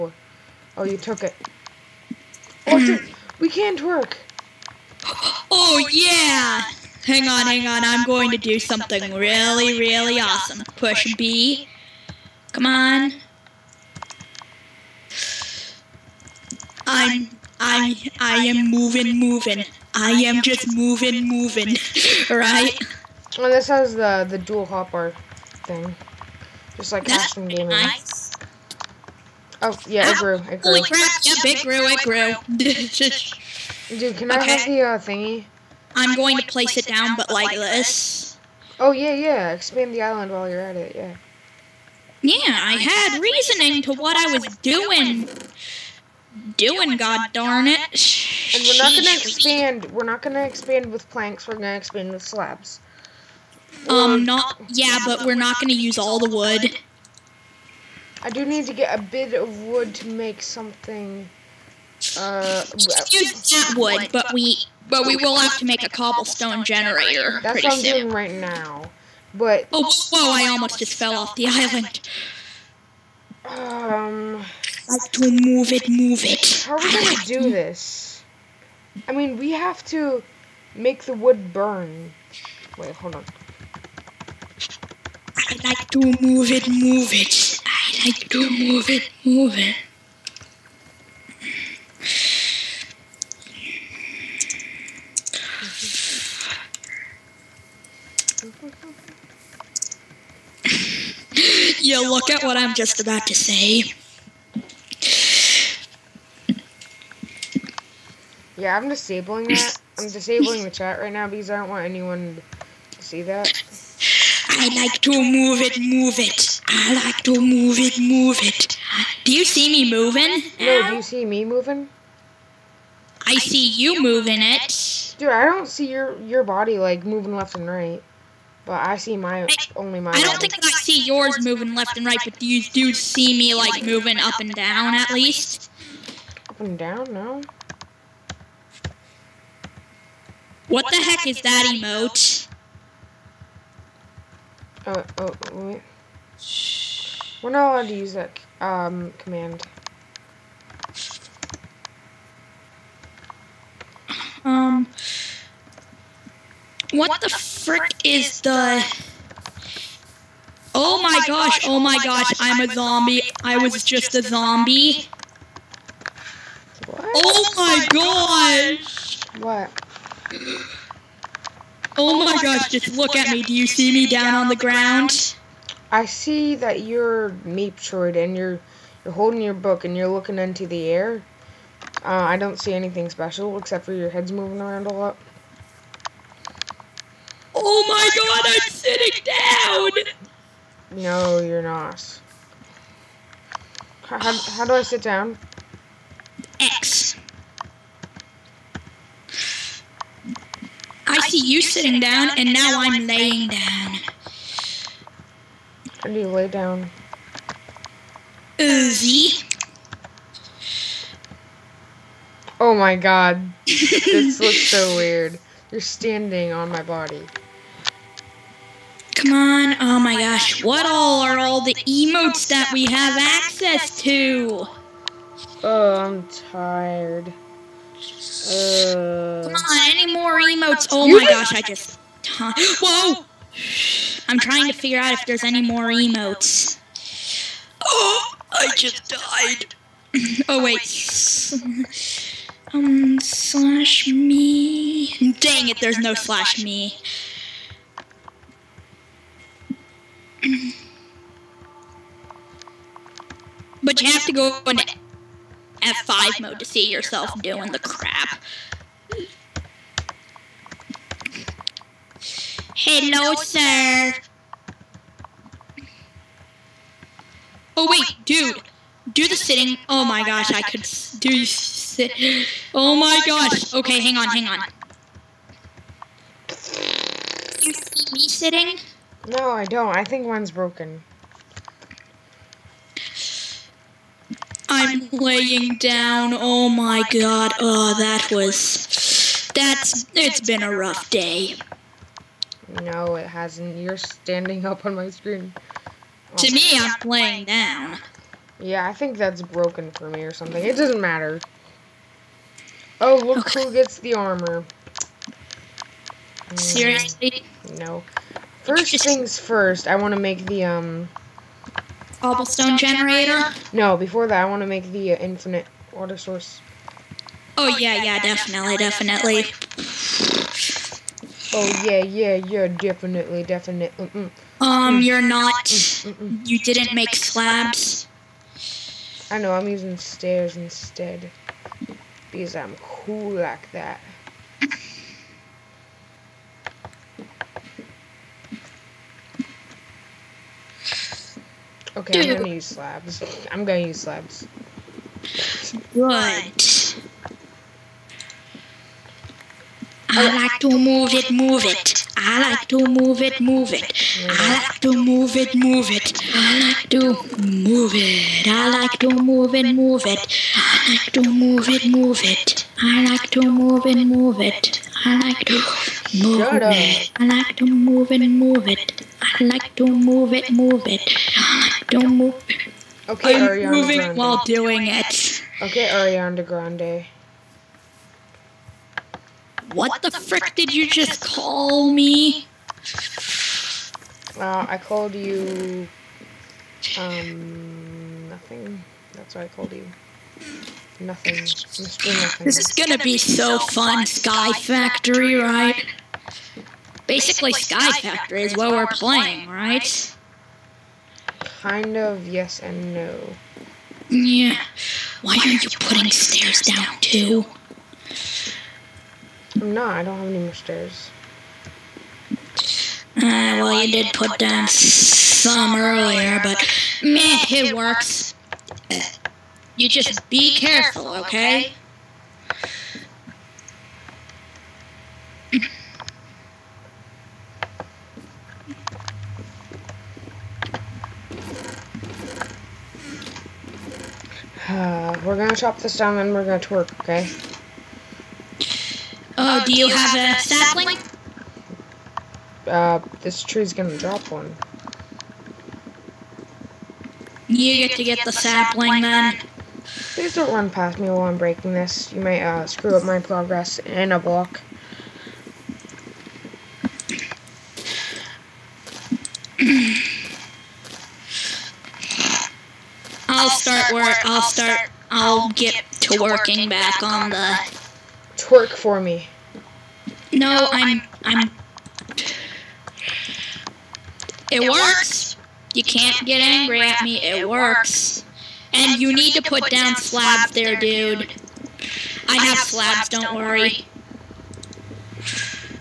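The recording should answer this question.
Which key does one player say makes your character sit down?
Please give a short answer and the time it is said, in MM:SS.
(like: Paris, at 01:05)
X, at 03:16.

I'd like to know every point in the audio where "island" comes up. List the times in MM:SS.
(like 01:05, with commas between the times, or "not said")
00:40, 01:11.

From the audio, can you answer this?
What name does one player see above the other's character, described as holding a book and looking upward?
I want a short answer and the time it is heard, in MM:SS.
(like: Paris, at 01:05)
Meeptroid, at 02:57.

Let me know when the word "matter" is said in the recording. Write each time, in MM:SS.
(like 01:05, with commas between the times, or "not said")
05:00.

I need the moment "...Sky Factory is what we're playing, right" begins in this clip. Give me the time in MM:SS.
06:37.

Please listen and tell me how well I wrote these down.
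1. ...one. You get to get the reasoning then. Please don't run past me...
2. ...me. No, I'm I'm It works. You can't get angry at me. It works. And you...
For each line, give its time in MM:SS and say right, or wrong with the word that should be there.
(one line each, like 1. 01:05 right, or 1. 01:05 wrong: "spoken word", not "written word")
1. 07:24 wrong: "sapling", not "reasoning"
2. 07:48 right.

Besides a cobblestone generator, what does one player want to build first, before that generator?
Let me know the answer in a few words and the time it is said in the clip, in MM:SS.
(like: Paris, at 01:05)
Infinite water source, at 05:15.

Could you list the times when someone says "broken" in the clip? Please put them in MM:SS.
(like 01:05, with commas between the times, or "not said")
04:40, 04:59.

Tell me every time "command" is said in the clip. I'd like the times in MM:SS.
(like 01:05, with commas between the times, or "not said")
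02:29.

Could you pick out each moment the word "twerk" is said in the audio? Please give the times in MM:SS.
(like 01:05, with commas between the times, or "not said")
07:16, 07:48.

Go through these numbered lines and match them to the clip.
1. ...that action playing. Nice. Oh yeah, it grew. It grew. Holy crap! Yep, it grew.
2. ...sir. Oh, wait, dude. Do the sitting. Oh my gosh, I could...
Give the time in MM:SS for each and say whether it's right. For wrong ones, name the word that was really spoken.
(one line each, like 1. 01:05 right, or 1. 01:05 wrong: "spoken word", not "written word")
1. 00:27 wrong: "gaming", not "playing"
2. 04:23 right.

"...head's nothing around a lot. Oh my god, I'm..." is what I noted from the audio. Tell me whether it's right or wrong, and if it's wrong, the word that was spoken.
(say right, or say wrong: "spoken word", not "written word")
wrong: "moving", not "nothing".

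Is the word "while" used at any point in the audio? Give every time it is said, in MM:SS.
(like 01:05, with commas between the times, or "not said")
00:40, 06:14, 07:31.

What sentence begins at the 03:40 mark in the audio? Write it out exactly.
What all are all the emotes that we have access to?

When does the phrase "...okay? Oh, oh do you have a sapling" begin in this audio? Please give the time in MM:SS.
07:17.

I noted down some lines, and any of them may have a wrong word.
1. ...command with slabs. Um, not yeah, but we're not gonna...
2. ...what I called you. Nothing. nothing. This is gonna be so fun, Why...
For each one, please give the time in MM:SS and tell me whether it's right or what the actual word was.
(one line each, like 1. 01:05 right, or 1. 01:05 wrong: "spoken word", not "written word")
1. 00:51 wrong: "expand", not "command"
2. 06:29 wrong: "Sky", not "Why".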